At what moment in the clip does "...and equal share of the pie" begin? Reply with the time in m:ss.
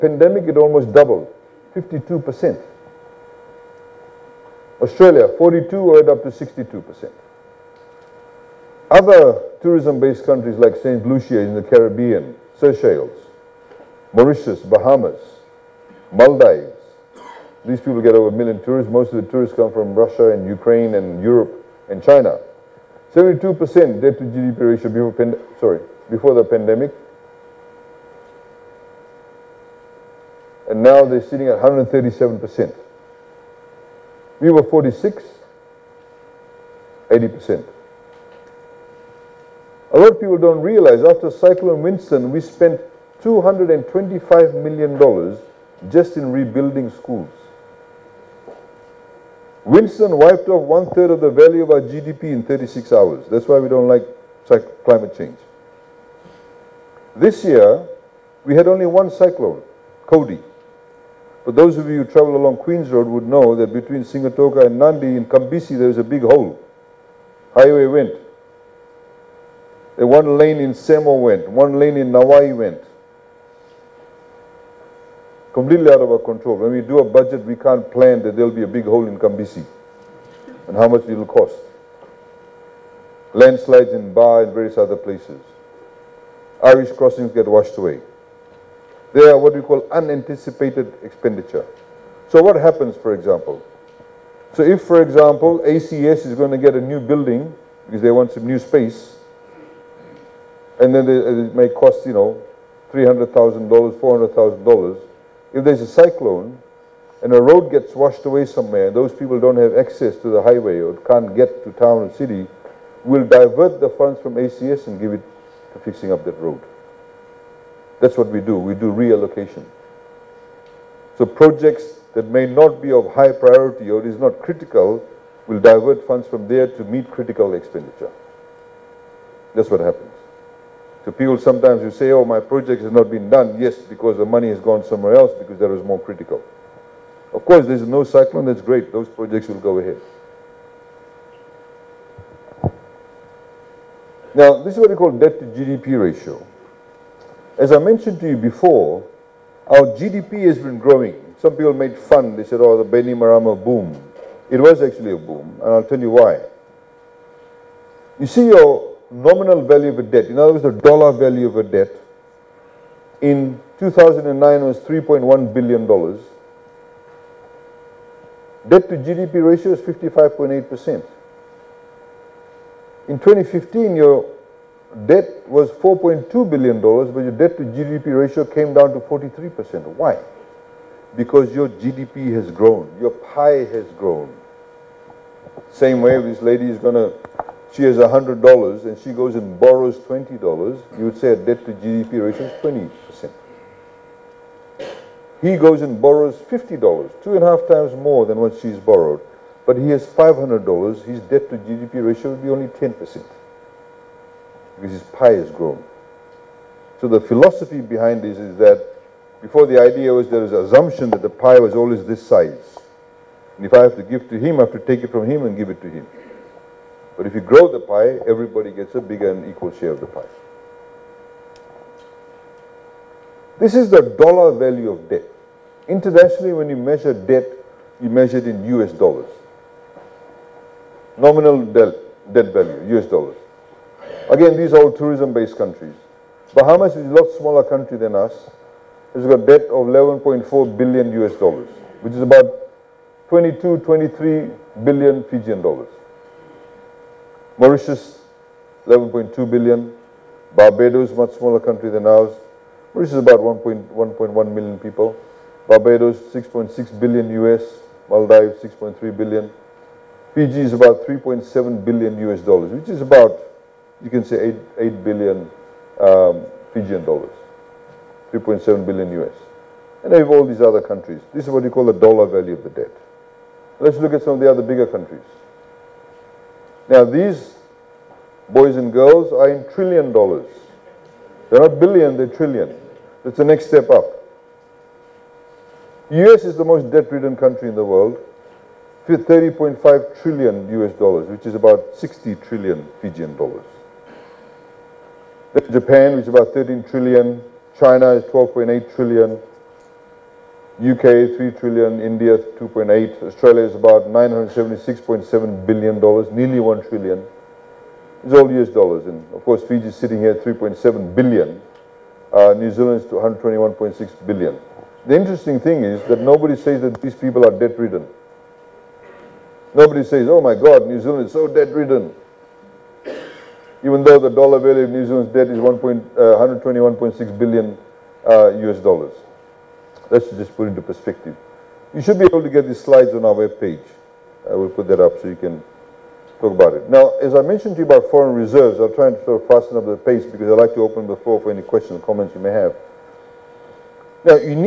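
3:39.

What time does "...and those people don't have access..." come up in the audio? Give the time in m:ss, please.
1:48.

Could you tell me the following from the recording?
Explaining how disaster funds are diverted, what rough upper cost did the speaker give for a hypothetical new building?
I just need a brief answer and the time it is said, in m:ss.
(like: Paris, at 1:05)
$400,000, at 1:43.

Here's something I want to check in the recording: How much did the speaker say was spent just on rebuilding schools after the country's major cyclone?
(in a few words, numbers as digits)
$225 million.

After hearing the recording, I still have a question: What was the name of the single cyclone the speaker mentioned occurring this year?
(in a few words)
Cody.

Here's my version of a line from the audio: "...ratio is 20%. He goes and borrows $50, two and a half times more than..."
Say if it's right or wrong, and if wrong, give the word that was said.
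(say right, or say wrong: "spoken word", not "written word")
right.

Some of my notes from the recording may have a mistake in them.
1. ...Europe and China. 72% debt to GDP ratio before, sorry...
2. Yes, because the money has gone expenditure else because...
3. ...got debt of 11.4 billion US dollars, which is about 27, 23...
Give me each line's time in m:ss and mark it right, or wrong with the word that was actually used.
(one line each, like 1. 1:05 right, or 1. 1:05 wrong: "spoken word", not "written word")
1. 0:21 right
2. 2:13 wrong: "somewhere", not "expenditure"
3. 3:59 wrong: "22", not "27".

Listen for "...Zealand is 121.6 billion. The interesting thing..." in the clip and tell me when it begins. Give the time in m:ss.
5:12.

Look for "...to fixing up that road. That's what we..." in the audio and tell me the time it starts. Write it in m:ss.
1:55.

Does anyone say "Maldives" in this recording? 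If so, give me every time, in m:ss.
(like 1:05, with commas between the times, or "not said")
0:16, 4:18.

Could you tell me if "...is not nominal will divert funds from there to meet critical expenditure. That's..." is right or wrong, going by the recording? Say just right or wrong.
wrong.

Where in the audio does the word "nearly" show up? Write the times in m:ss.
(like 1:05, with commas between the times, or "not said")
5:06.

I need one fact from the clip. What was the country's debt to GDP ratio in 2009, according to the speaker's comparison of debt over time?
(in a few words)
55.8%.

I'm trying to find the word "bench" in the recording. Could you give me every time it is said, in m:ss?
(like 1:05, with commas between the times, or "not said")
not said.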